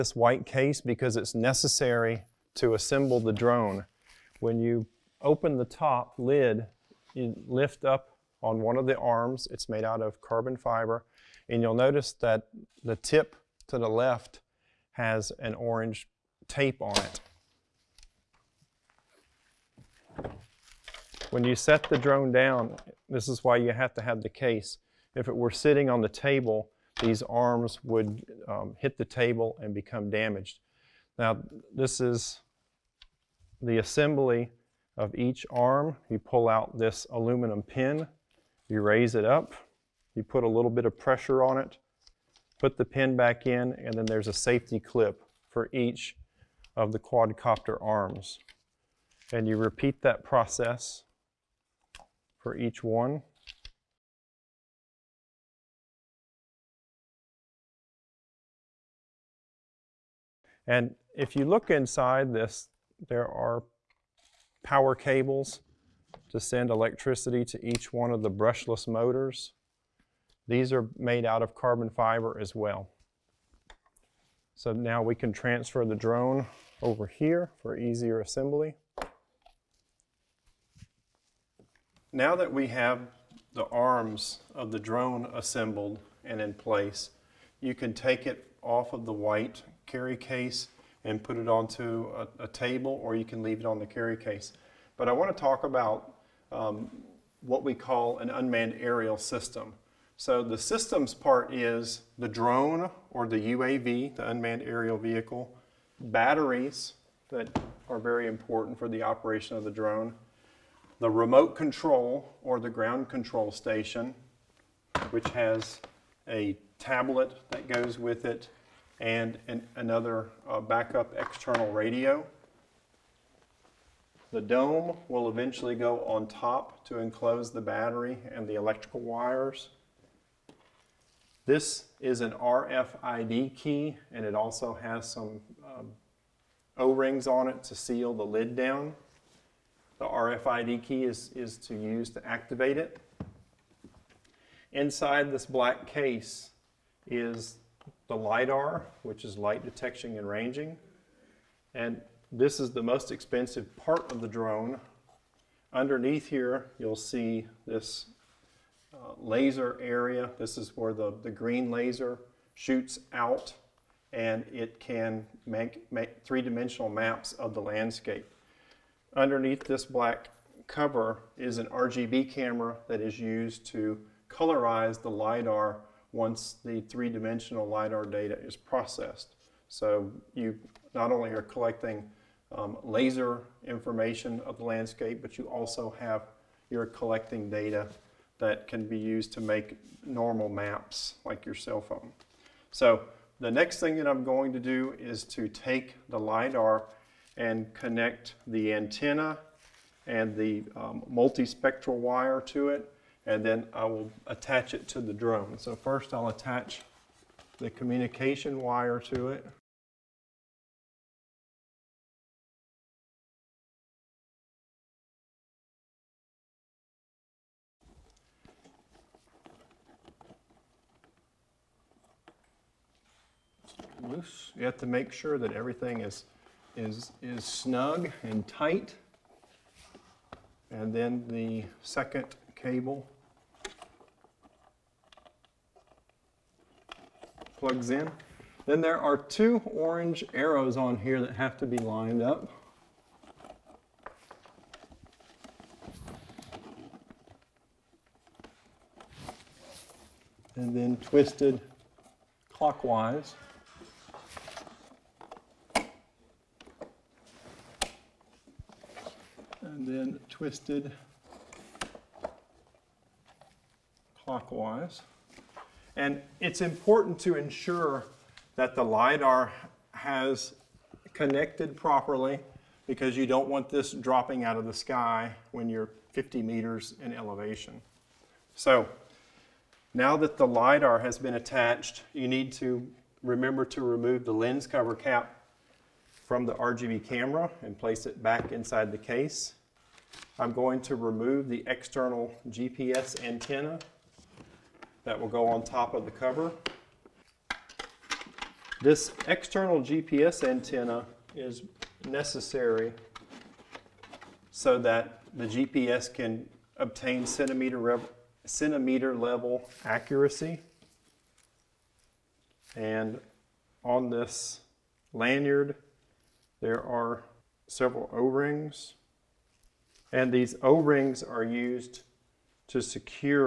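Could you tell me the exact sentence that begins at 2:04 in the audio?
The dome will eventually go on top to enclose the battery and the electrical wires.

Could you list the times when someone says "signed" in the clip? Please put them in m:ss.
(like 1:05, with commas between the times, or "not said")
not said.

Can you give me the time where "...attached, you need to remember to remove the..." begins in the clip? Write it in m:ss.
4:41.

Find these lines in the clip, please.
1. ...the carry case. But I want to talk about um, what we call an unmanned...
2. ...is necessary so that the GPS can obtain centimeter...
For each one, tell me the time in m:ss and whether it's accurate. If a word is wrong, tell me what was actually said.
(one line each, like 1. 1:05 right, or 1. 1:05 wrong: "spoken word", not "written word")
1. 1:33 right
2. 5:01 right.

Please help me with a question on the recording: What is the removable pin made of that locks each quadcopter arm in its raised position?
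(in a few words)
Aluminum.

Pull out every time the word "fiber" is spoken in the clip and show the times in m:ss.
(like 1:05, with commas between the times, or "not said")
0:10, 1:11.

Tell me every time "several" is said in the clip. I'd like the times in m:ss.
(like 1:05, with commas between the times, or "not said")
5:17.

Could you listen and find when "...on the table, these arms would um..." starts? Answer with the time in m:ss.
0:25.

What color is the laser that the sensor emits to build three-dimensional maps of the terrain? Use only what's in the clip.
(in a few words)
Green.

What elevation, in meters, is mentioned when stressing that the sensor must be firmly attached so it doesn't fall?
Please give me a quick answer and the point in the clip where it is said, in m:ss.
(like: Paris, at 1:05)
50 meters, at 4:36.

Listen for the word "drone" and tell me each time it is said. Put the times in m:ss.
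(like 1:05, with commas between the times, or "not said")
0:03, 0:21, 1:15, 1:24, 1:42, 1:49, 2:34, 3:25.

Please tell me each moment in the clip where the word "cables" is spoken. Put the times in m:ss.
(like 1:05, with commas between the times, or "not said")
1:04, 3:52.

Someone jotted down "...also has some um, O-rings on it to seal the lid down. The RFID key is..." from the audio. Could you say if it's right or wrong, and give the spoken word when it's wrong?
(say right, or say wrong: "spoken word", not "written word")
right.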